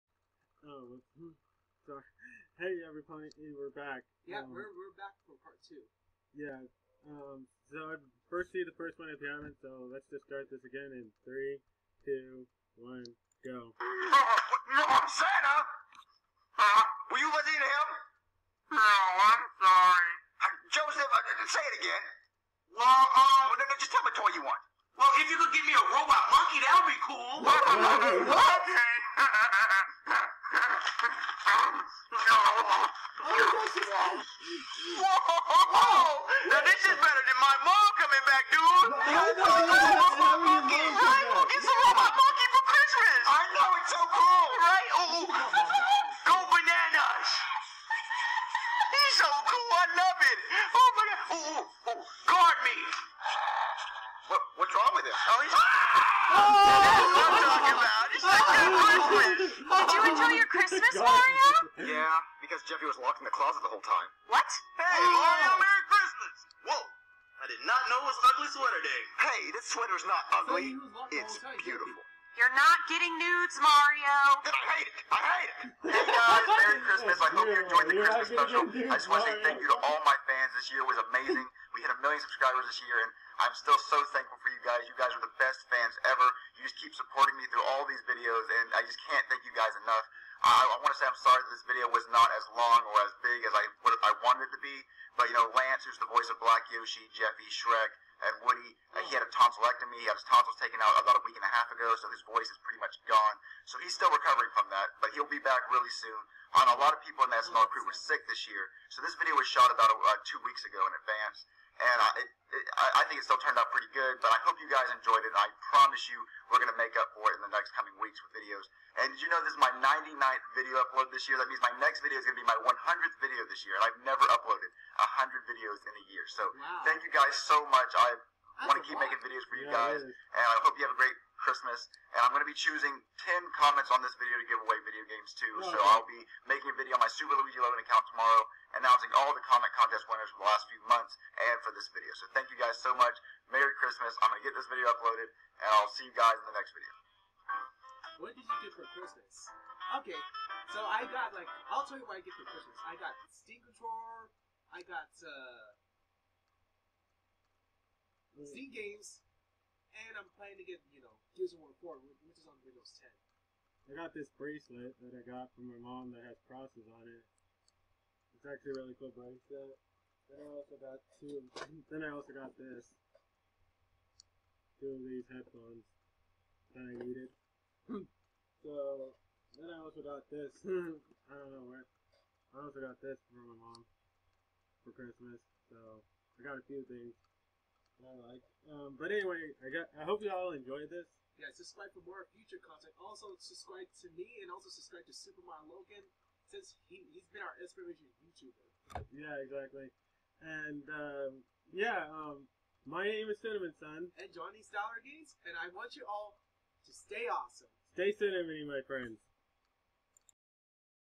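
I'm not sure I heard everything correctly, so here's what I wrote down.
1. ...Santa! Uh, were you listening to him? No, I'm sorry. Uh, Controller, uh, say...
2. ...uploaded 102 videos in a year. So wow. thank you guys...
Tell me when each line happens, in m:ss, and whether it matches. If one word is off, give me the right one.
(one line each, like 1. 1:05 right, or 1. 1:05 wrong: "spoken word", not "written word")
1. 0:15 wrong: "Joseph", not "Controller"
2. 2:04 wrong: "100", not "102".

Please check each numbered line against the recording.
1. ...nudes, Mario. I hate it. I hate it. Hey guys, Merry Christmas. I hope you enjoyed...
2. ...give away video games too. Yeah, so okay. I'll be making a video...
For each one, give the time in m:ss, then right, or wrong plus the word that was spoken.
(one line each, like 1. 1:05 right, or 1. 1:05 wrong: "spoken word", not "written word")
1. 1:13 right
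2. 2:14 right.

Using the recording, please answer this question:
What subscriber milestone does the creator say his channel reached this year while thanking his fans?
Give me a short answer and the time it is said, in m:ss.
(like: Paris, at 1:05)
a million, at 1:21.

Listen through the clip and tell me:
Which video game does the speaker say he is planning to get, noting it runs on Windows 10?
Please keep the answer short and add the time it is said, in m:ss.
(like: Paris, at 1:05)
Gears of War 4, at 2:41.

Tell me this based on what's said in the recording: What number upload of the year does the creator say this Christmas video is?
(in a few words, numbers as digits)
99th.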